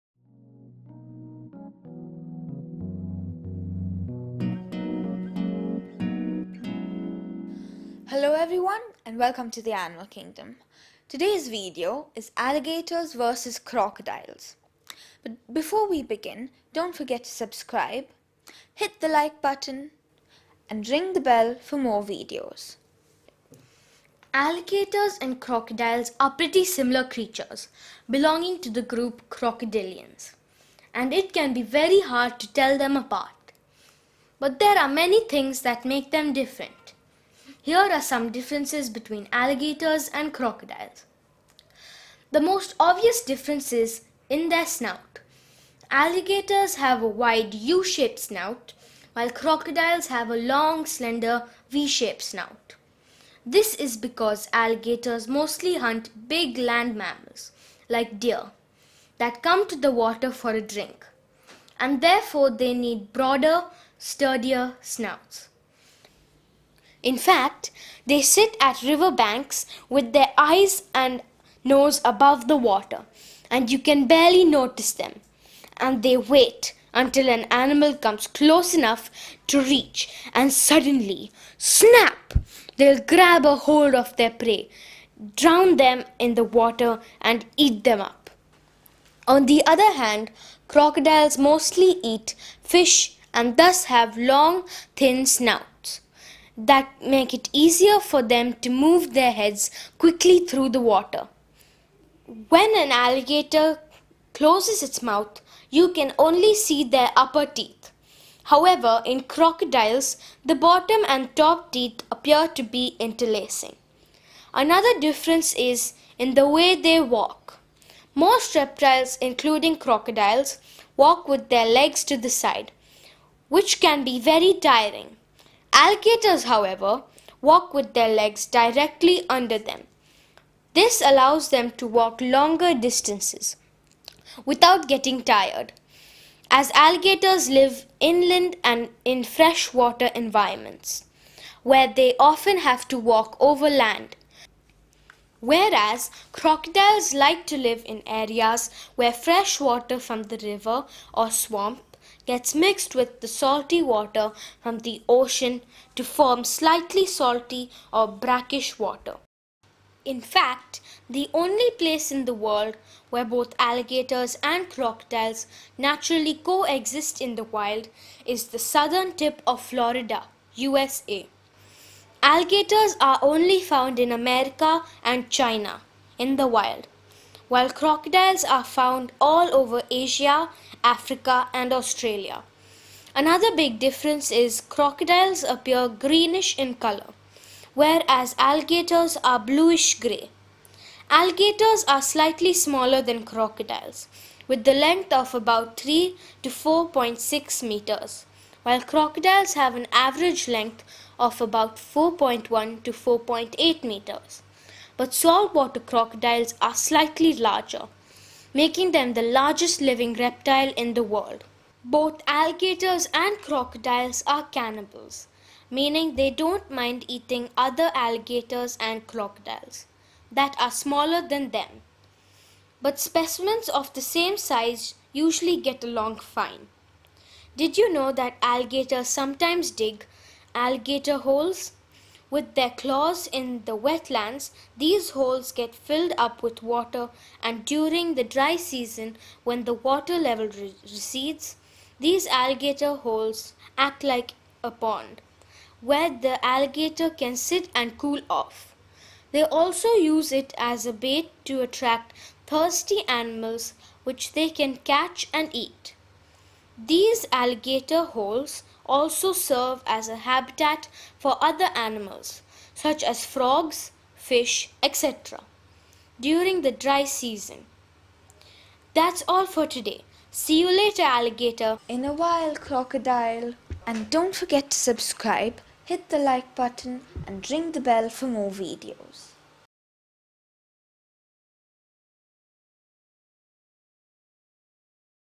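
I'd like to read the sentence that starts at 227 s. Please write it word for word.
Did you know that alligators sometimes dig alligator holes?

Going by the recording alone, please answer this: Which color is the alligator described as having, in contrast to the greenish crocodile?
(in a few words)
Bluish grey.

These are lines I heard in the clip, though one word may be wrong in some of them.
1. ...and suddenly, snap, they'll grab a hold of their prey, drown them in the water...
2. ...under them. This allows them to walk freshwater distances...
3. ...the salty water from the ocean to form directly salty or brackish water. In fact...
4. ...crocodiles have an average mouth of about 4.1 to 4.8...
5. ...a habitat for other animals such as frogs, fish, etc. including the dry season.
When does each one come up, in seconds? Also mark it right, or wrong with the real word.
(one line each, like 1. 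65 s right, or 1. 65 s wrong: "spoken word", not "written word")
1. 80 s right
2. 129 s wrong: "longer", not "freshwater"
3. 153 s wrong: "slightly", not "directly"
4. 198 s wrong: "length", not "mouth"
5. 260 s wrong: "during", not "including".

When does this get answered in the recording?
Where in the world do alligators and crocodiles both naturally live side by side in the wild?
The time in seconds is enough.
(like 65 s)
168 s.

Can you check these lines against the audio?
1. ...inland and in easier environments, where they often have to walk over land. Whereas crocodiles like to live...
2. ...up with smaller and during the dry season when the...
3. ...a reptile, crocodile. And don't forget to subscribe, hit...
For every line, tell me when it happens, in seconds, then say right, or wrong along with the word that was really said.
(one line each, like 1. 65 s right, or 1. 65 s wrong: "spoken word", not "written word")
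1. 137 s wrong: "freshwater", not "easier"
2. 236 s wrong: "water", not "smaller"
3. 272 s wrong: "while", not "reptile".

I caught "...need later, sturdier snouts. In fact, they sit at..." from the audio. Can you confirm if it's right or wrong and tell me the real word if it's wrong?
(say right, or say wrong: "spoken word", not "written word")
wrong: "broader", not "later".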